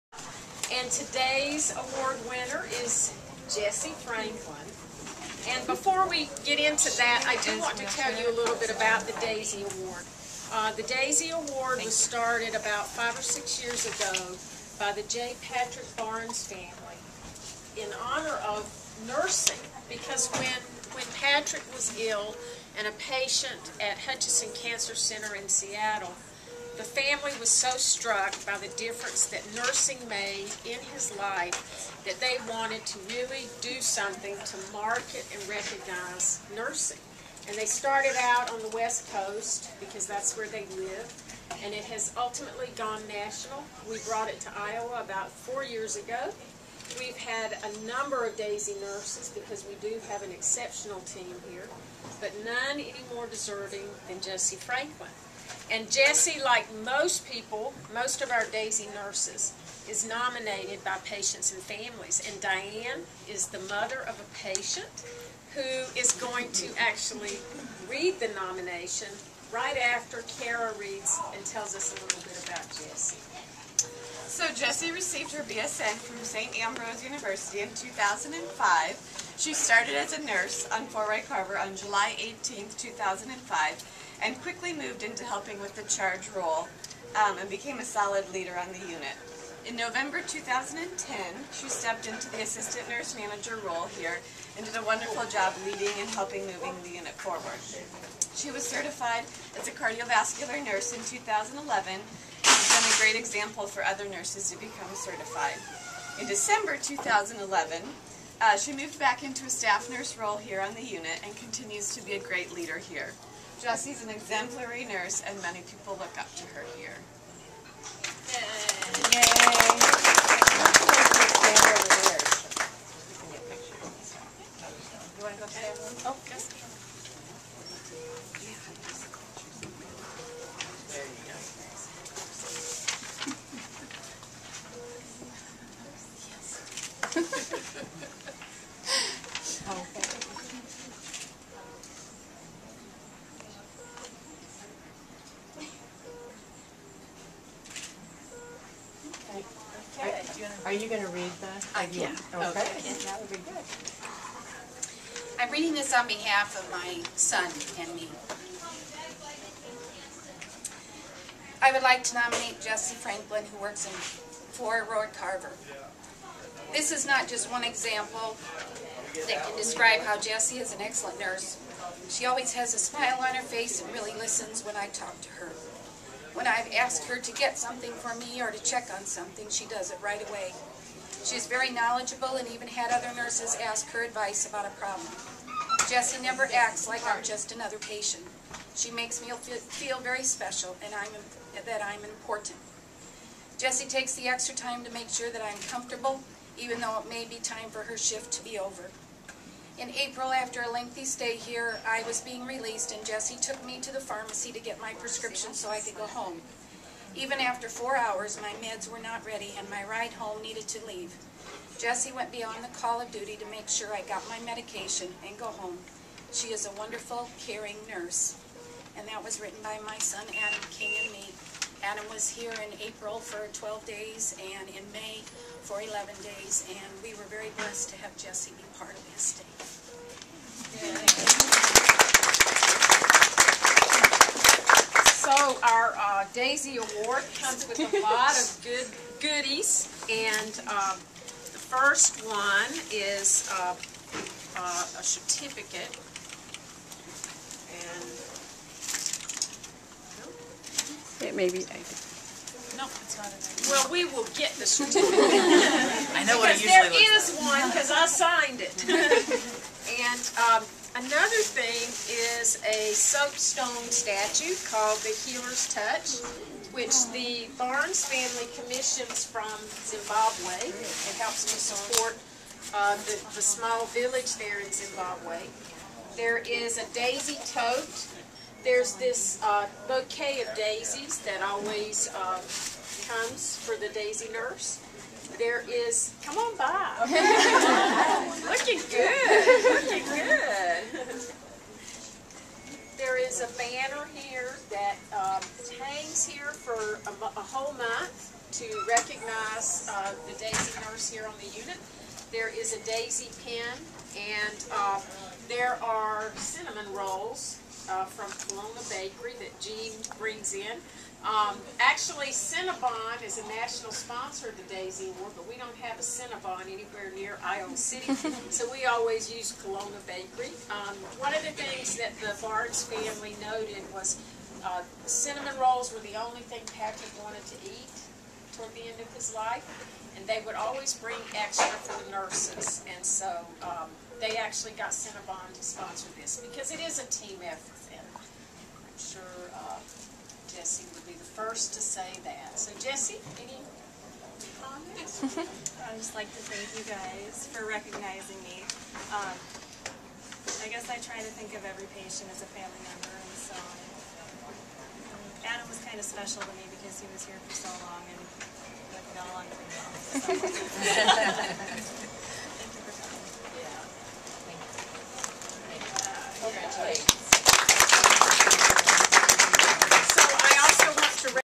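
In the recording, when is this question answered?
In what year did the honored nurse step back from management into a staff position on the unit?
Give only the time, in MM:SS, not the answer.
01:46.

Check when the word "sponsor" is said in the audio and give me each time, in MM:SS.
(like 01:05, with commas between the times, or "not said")
05:13, 05:35.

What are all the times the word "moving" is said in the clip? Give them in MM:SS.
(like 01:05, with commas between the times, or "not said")
01:36.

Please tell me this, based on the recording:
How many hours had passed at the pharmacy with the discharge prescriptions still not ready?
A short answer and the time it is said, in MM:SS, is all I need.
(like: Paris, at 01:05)
4, at 03:27.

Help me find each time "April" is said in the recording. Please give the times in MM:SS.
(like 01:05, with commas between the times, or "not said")
03:19, 03:42.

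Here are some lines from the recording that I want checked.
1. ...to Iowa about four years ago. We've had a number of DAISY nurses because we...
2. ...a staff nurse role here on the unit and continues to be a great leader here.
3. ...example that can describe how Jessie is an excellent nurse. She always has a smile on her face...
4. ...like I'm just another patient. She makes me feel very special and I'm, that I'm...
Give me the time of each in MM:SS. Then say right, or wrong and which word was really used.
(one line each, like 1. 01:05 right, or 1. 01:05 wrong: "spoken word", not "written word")
1. 00:44 right
2. 01:49 right
3. 02:47 right
4. 03:06 right.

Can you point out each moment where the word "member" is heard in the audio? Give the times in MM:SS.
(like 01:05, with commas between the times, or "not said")
05:52.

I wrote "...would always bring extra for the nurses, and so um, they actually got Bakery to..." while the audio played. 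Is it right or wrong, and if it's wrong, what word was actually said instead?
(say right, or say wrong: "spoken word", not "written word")
wrong: "Cinnabon", not "Bakery".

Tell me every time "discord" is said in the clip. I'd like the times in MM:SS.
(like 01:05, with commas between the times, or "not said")
not said.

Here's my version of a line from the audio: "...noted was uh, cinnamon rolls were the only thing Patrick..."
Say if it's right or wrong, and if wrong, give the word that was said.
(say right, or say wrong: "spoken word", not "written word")
right.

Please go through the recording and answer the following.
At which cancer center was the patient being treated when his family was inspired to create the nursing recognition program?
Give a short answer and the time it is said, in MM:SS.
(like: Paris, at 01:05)
Hutchinson Cancer Center, at 00:23.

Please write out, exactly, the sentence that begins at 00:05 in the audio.
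And before we get into that, I do want to tell you a little bit about the DAISY Award.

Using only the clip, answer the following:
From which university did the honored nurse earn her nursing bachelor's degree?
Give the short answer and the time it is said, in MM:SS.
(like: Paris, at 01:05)
St. Ambrose University, at 01:16.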